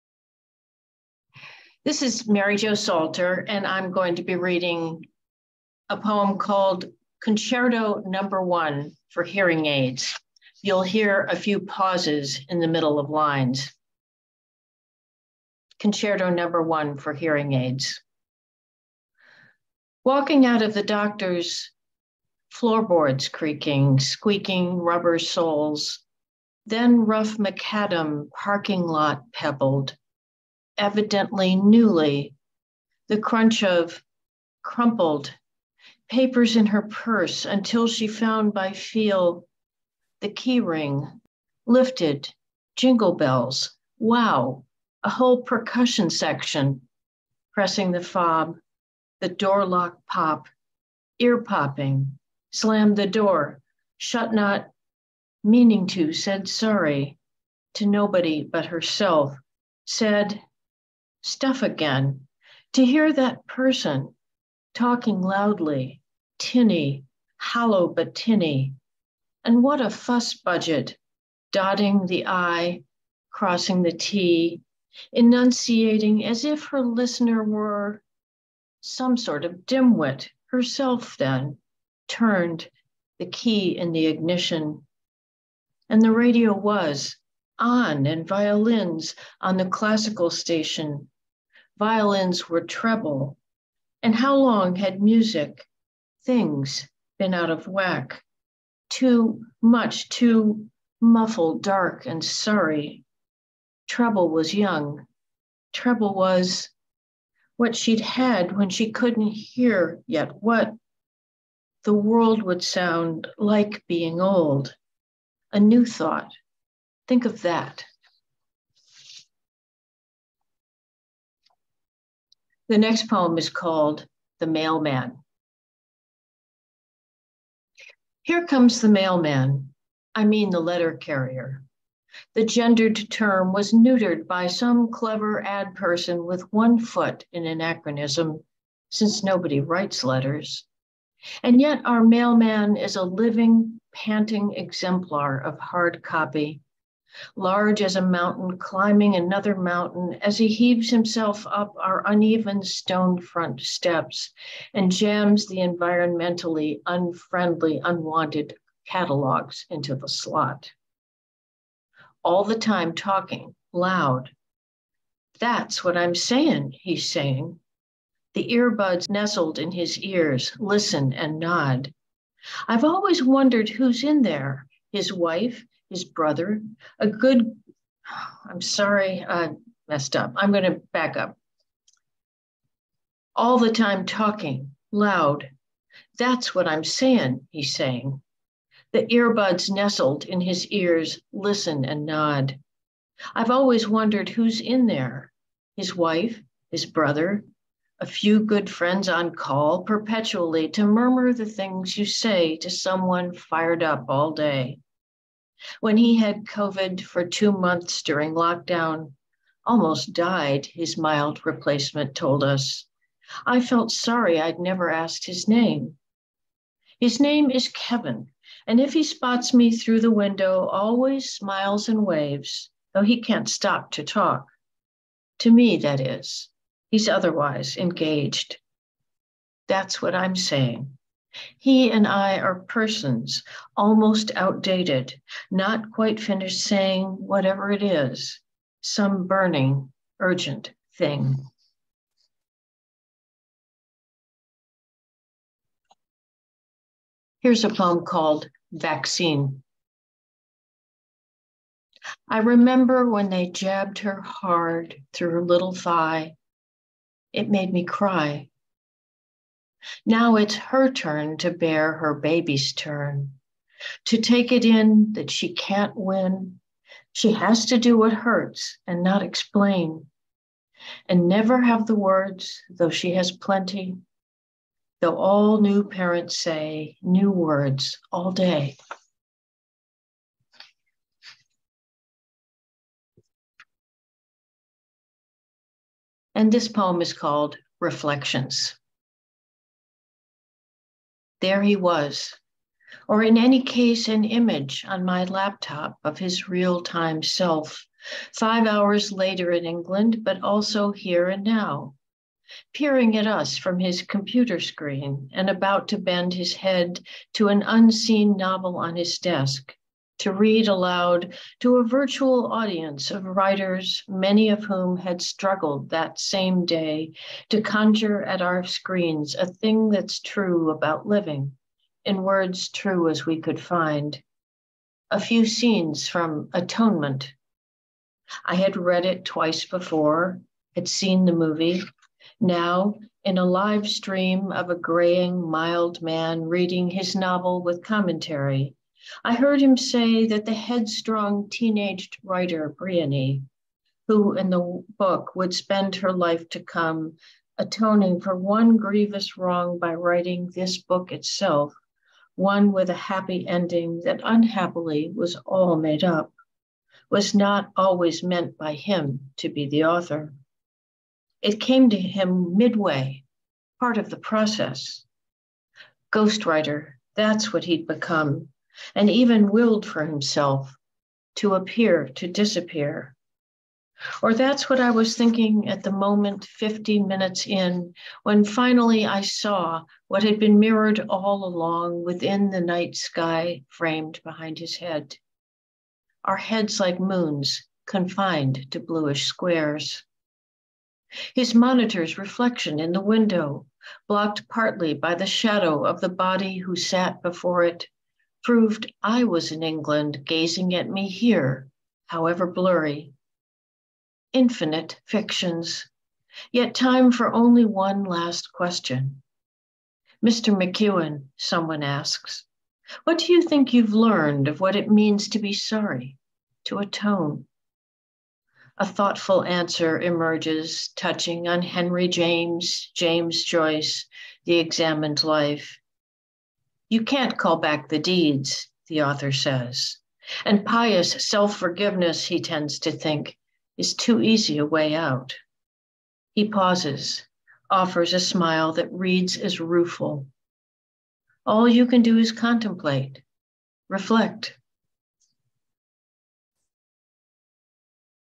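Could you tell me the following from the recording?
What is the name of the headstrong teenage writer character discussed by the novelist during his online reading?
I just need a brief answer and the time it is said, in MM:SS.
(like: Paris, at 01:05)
Briony, at 05:42.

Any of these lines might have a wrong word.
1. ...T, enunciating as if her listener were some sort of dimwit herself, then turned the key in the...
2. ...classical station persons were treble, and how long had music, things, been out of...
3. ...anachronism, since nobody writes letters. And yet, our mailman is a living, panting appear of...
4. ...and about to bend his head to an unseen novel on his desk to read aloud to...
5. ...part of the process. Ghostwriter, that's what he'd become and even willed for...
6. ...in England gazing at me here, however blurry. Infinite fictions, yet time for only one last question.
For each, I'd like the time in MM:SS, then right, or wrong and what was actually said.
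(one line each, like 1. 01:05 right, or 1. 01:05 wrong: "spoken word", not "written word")
1. 01:13 right
2. 01:29 wrong: "violins", not "persons"
3. 02:17 wrong: "exemplar", not "appear"
4. 05:05 right
5. 06:03 right
6. 06:39 right.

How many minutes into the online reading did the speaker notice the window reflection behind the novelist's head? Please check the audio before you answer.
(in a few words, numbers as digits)
50.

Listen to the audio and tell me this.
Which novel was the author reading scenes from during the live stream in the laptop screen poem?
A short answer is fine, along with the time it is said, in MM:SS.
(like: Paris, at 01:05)
Atonement, at 05:26.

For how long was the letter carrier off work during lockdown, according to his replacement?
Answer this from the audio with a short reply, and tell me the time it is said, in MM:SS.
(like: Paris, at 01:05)
2 months, at 03:27.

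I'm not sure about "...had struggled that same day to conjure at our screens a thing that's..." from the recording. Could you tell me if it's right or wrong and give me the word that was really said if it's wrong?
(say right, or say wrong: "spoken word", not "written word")
right.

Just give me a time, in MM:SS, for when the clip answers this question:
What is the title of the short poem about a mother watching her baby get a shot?
04:08.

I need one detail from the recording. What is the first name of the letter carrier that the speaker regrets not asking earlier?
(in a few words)
Kevin.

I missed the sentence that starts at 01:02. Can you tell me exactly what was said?
To hear that person talking loudly, tinny, hollow but tinny.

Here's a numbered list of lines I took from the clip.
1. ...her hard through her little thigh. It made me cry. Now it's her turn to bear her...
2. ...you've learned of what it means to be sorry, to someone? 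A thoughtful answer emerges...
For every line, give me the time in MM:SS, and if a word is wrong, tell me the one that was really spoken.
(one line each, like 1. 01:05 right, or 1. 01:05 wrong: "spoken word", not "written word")
1. 04:13 right
2. 06:53 wrong: "atone", not "someone".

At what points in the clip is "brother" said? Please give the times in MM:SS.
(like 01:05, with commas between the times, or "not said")
02:56, 03:16.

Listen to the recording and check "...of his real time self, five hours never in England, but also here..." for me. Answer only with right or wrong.
wrong.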